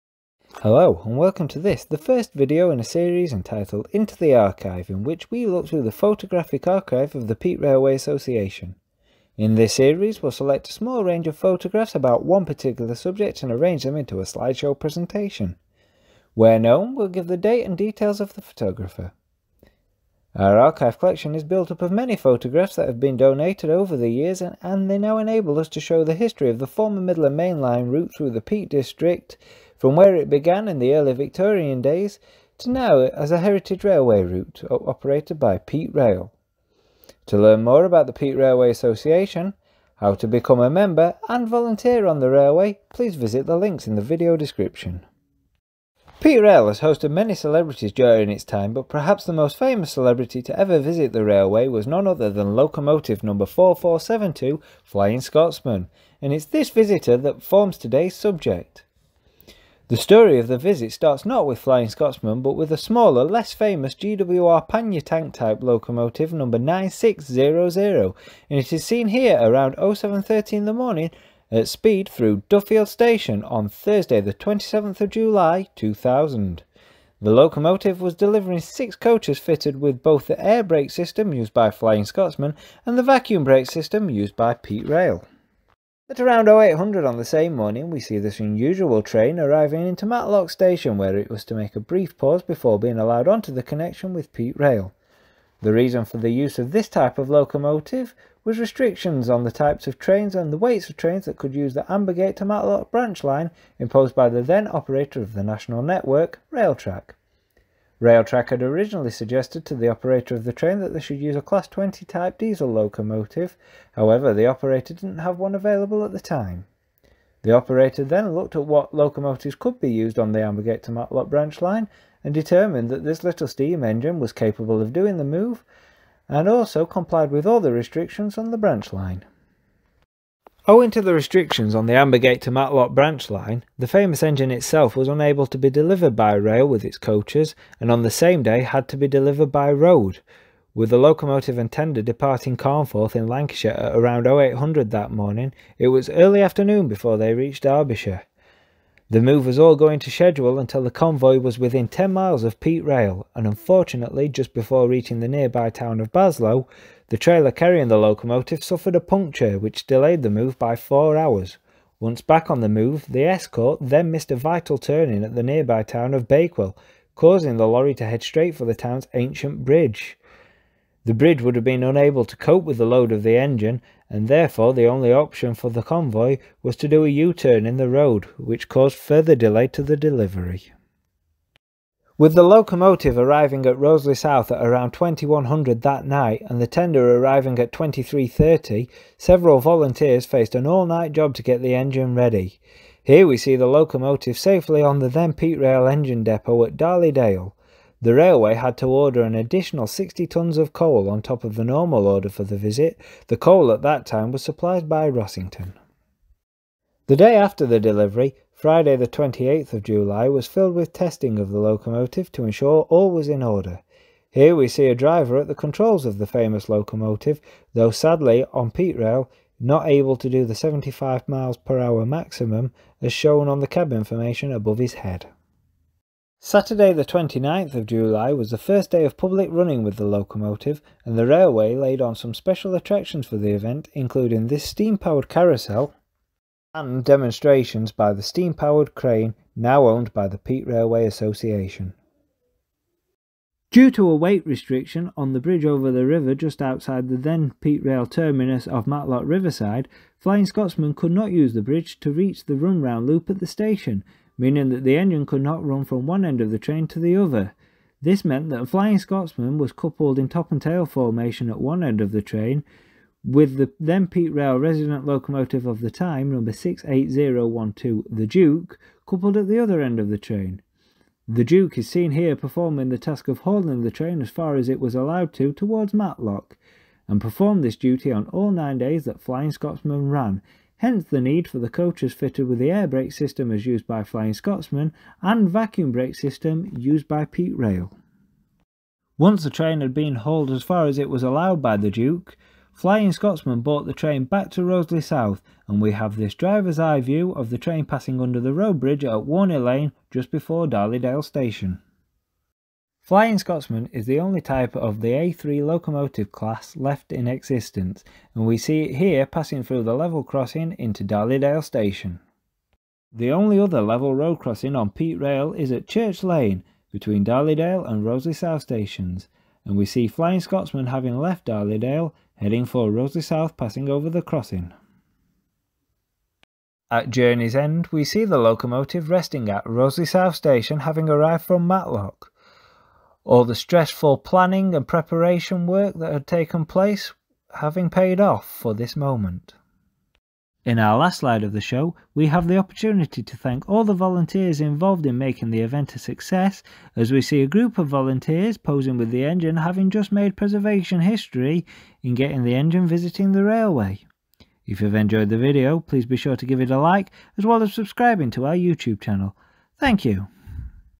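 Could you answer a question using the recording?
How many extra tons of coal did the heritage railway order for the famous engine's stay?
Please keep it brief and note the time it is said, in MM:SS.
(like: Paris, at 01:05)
60, at 03:19.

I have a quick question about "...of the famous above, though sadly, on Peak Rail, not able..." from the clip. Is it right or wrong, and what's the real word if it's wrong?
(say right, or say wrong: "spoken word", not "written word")
wrong: "locomotive", not "above".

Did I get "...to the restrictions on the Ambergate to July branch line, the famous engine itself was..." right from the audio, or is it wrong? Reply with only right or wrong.
wrong.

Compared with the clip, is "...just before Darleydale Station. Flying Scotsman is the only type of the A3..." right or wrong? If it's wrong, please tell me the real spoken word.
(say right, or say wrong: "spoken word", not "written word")
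right.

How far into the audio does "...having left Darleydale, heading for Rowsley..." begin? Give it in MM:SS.
05:20.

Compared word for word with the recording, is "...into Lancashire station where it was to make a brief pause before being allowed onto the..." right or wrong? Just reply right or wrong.
wrong.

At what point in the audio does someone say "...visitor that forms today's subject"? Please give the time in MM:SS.
00:56.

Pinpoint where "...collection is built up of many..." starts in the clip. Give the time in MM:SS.
00:20.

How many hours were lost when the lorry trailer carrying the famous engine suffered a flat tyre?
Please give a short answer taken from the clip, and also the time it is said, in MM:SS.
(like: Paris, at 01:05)
4, at 02:40.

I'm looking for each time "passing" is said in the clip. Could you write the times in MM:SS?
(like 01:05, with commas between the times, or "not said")
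04:57, 05:09, 05:23.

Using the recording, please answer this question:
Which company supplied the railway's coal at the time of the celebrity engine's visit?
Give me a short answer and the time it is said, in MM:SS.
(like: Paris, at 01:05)
Rossington, at 03:25.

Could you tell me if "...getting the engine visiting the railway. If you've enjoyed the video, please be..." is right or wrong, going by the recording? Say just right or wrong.
right.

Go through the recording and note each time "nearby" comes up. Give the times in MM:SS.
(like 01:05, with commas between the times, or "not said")
02:35, 02:45.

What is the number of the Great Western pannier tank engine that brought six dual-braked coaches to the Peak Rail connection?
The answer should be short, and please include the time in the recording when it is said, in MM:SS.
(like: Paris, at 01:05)
9600, at 01:06.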